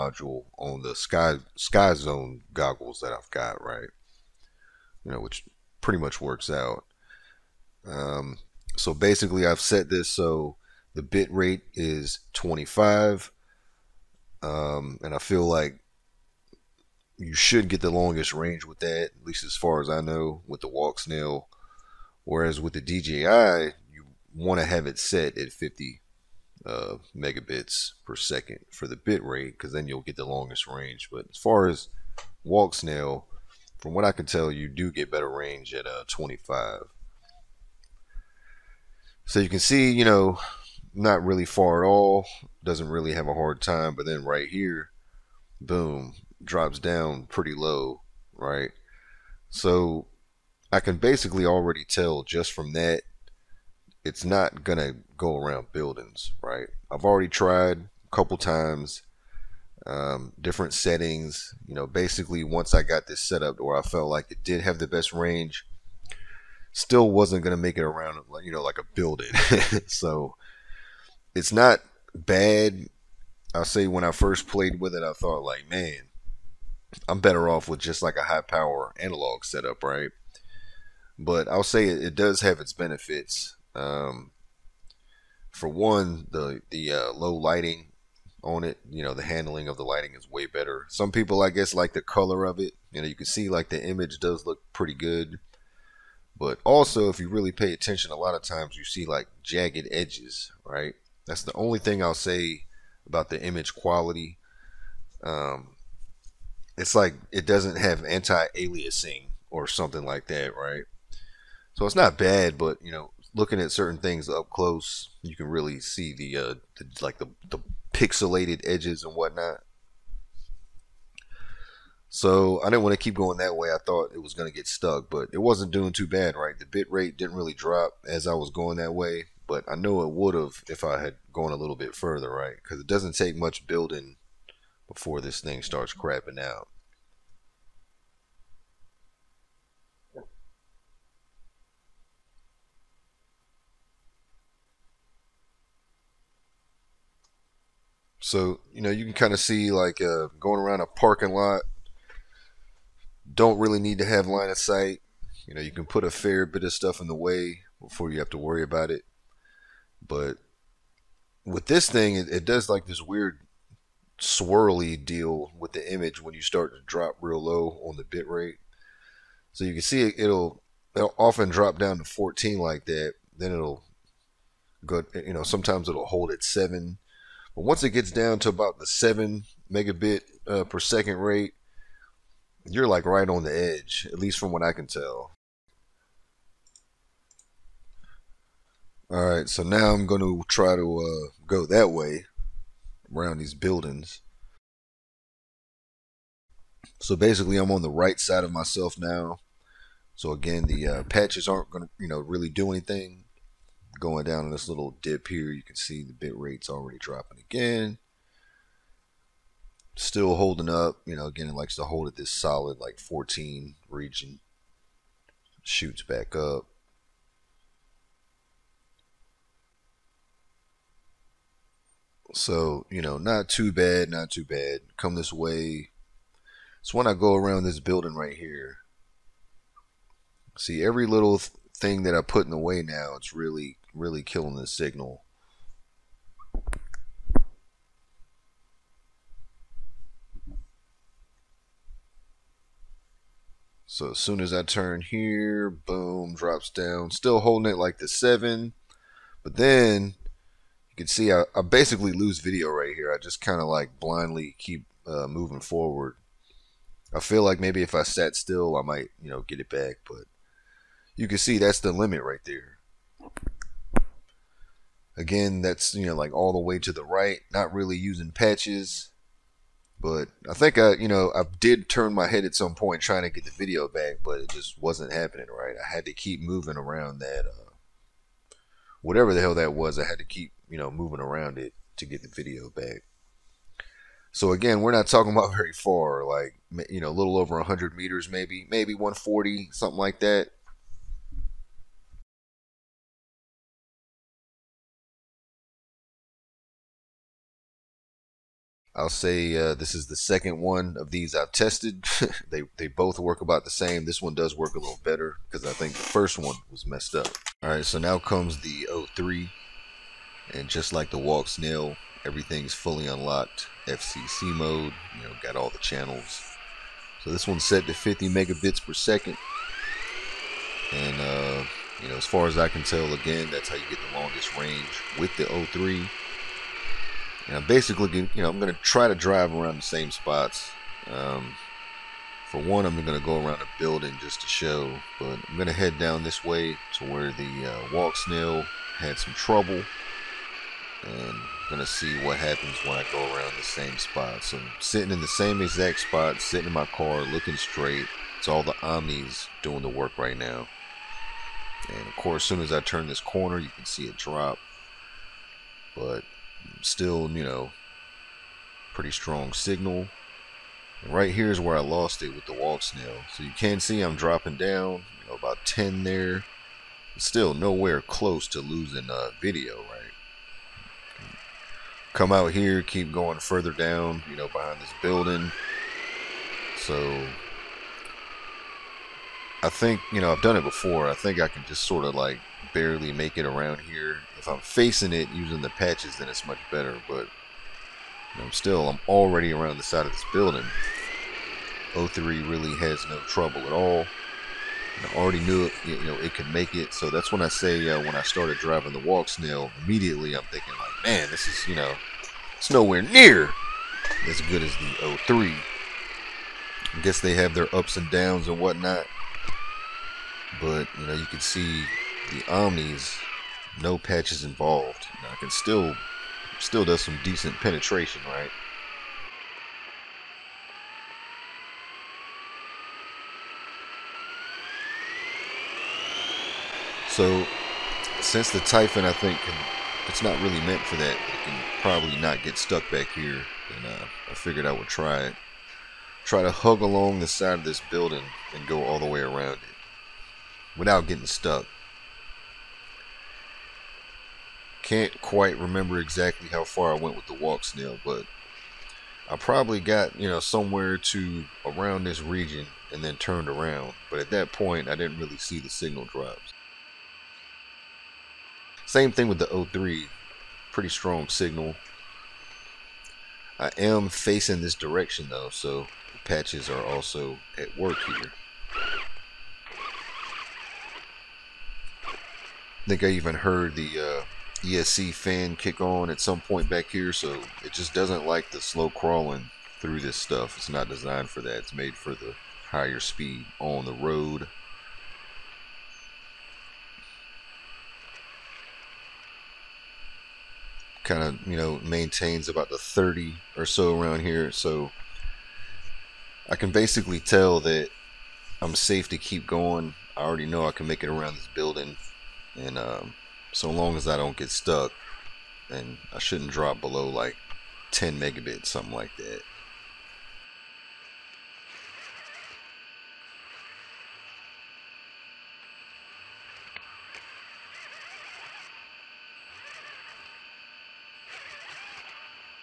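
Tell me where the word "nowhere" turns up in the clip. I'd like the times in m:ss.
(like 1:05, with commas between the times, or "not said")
6:07, 6:42.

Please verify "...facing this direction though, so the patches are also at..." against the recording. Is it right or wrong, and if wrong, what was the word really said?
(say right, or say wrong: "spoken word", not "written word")
right.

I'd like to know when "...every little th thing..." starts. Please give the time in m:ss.
3:50.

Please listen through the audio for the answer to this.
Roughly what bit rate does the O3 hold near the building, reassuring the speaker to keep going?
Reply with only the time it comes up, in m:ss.
8:12.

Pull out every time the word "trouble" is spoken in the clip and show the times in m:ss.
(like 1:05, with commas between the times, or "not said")
5:39, 6:33.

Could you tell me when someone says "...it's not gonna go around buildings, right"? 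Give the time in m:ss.
0:54.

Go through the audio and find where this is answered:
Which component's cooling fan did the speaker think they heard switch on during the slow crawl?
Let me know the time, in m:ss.
7:54.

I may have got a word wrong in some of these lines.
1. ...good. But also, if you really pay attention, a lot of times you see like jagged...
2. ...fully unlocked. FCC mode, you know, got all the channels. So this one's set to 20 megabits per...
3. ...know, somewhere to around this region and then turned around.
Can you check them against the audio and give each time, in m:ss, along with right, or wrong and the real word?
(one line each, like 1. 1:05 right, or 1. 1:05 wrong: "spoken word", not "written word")
1. 1:34 right
2. 5:12 wrong: "50", not "20"
3. 7:30 right.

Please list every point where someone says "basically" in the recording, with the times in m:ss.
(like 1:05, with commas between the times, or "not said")
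0:08, 0:50, 1:01, 3:17, 4:11, 5:27, 8:16.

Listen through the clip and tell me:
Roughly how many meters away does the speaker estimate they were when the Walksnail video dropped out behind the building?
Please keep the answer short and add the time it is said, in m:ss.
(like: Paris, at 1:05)
140, at 4:48.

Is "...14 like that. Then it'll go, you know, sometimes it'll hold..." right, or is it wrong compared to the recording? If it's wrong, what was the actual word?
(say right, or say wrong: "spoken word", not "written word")
right.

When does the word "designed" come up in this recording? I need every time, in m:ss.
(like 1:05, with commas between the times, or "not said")
8:00.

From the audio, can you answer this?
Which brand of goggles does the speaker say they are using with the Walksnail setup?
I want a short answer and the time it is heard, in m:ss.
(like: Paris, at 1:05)
Skyzone, at 0:01.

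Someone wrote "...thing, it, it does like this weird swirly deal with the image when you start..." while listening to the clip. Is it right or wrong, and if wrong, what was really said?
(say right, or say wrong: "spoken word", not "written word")
right.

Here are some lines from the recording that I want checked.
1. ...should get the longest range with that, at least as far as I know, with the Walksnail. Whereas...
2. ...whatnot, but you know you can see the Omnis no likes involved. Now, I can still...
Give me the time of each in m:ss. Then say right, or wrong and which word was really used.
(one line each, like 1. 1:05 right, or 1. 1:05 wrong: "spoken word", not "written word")
1. 0:17 right
2. 6:48 wrong: "patches", not "likes".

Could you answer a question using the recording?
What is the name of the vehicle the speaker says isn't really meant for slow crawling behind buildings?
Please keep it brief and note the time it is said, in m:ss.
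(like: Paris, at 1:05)
Typhon, at 7:08.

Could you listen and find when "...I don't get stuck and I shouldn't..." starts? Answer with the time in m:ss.
8:24.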